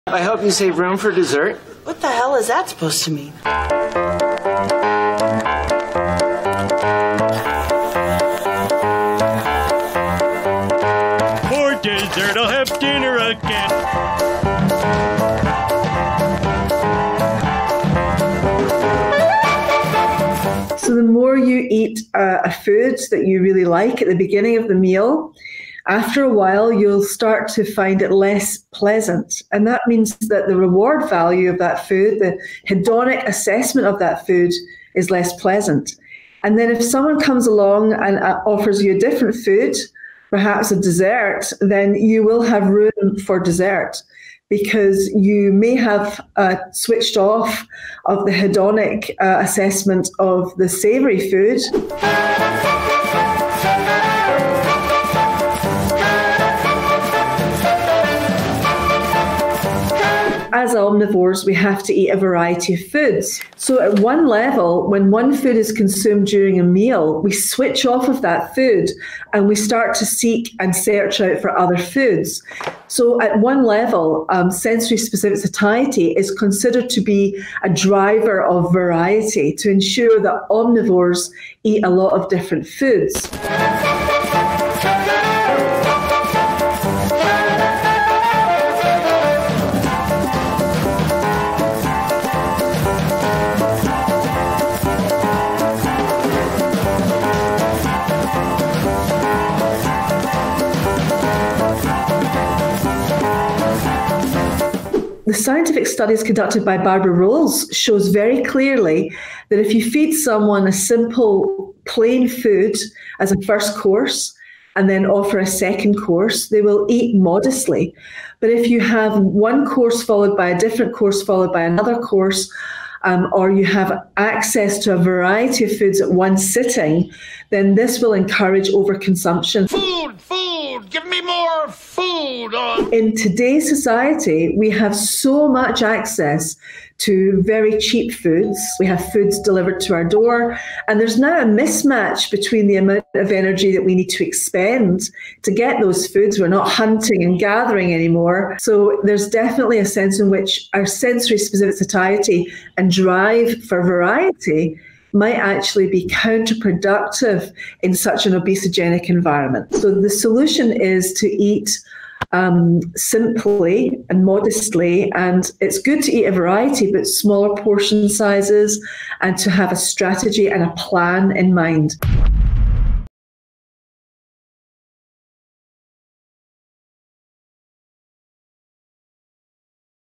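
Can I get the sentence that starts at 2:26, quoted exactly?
We're not hunting and gathering anymore.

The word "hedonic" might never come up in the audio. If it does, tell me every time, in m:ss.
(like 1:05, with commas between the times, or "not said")
0:32, 0:48.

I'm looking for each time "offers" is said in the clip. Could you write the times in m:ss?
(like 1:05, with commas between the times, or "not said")
0:38, 1:55.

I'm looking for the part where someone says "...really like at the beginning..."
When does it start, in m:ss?
0:23.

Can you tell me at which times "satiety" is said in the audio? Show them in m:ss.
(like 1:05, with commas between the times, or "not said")
1:15, 2:31.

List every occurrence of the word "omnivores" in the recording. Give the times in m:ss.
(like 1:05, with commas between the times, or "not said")
1:00, 1:20.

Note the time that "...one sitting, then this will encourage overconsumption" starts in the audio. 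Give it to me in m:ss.
2:06.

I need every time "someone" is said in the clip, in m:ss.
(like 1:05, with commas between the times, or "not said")
0:36, 1:50.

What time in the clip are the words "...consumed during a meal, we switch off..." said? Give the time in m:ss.
1:05.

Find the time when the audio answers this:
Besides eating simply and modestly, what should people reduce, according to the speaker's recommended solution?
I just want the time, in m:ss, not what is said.
2:47.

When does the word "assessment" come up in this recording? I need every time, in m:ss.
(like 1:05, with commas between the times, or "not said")
0:33, 0:49.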